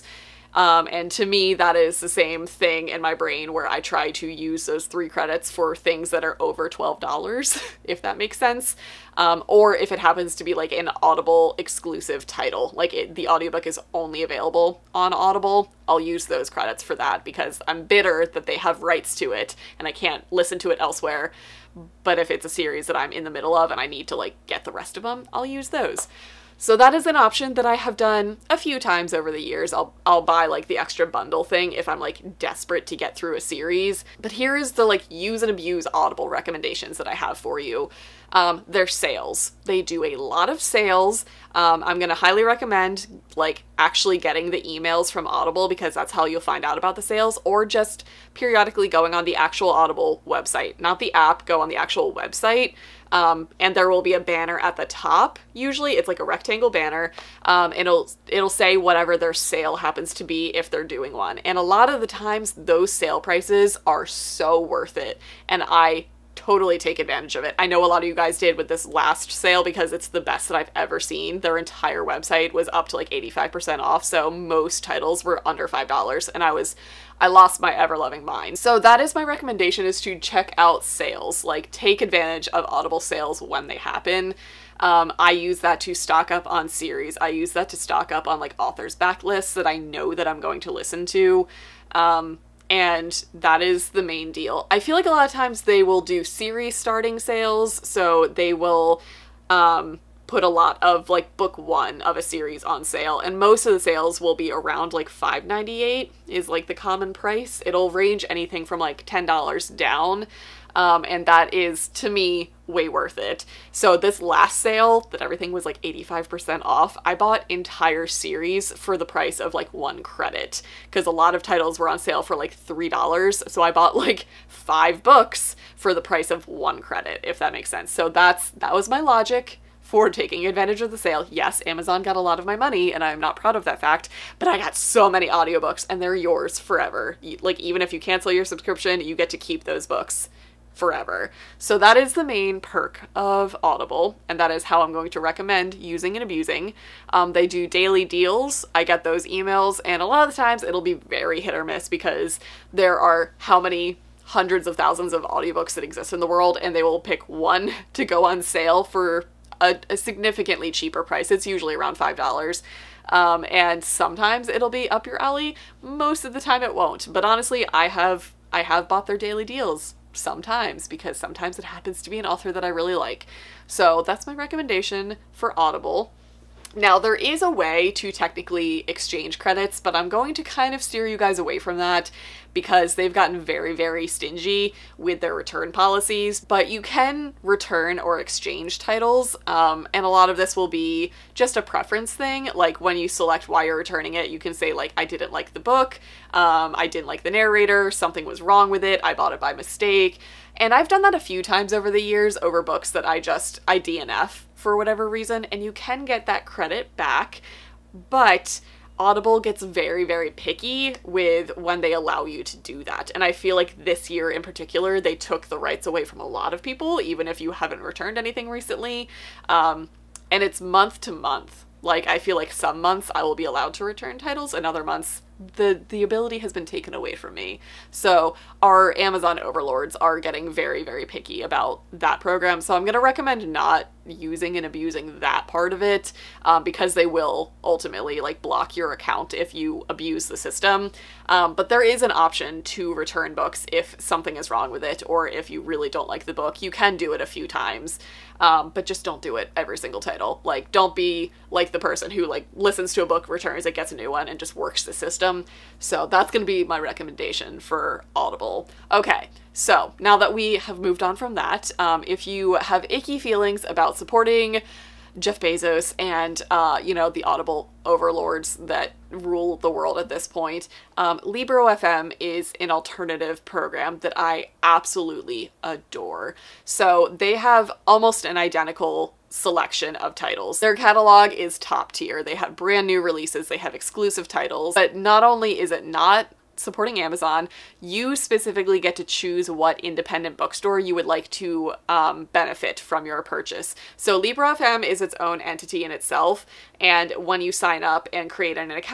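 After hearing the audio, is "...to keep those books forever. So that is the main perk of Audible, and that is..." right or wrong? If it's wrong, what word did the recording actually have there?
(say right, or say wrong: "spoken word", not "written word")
right.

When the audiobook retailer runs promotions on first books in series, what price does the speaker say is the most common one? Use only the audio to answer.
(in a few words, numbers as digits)
5.98.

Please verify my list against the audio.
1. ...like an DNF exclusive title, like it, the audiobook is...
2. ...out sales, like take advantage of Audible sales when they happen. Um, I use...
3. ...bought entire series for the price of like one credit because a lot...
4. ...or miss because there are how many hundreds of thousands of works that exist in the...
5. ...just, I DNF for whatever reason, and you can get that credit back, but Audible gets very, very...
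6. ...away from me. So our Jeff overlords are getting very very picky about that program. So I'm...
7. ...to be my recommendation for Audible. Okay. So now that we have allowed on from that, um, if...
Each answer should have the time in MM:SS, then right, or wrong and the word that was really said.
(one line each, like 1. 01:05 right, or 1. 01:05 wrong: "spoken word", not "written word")
1. 00:10 wrong: "Audible", not "DNF"
2. 01:20 right
3. 01:57 right
4. 02:31 wrong: "audiobooks", not "works"
5. 03:23 right
6. 03:46 wrong: "Amazon", not "Jeff"
7. 04:16 wrong: "moved", not "allowed".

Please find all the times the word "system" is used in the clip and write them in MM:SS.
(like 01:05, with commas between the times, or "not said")
04:00, 04:14.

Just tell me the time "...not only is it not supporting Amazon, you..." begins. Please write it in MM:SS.
04:44.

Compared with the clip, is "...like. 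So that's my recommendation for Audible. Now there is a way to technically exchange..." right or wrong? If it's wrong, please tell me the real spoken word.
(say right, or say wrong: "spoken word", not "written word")
right.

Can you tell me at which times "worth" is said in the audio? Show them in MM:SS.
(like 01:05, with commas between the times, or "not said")
01:04, 01:52.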